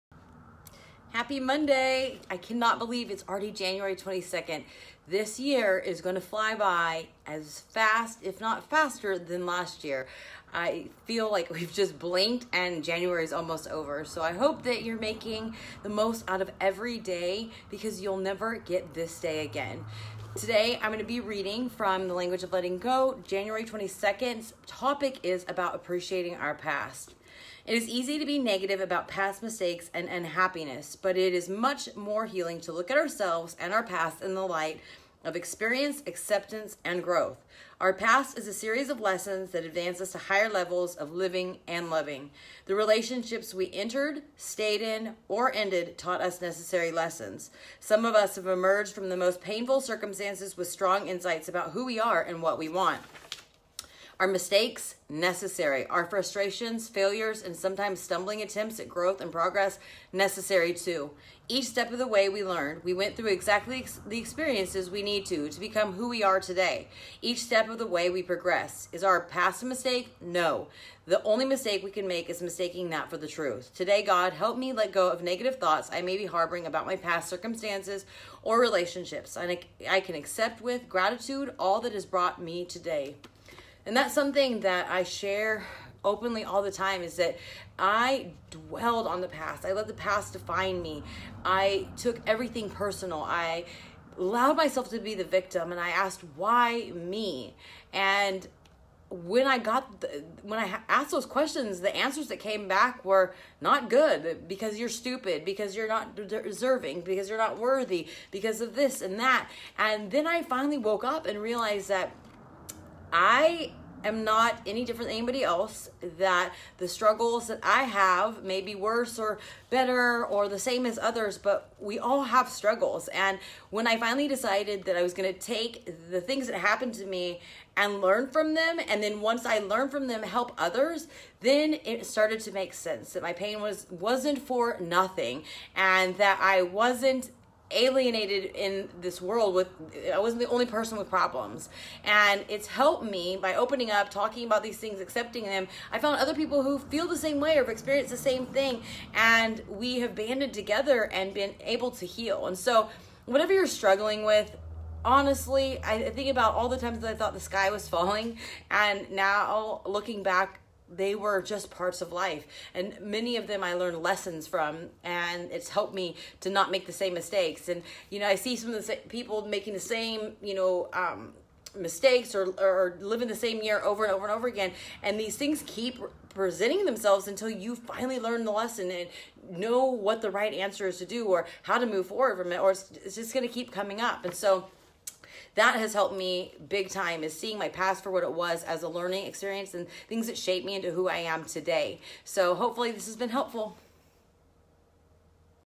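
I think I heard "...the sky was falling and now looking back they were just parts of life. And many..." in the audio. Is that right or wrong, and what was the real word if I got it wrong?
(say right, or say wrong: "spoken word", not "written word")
right.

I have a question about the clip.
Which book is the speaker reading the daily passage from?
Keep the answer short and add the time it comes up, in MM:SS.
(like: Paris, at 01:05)
The Language of Letting Go, at 00:22.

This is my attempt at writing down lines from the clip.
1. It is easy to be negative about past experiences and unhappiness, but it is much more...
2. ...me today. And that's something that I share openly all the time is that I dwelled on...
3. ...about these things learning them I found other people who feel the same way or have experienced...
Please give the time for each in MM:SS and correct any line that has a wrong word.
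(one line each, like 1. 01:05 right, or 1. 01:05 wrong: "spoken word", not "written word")
1. 00:27 wrong: "mistakes", not "experiences"
2. 01:22 right
3. 02:24 wrong: "accepting", not "learning".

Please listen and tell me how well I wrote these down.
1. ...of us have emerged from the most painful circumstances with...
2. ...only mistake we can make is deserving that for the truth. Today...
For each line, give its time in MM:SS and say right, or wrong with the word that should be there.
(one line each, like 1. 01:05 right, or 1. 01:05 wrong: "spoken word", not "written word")
1. 00:48 right
2. 01:11 wrong: "mistaking", not "deserving".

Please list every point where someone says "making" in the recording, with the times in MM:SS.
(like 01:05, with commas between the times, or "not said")
00:14, 02:49.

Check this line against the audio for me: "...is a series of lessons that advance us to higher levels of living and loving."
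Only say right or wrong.
right.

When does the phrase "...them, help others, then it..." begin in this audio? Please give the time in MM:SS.
02:10.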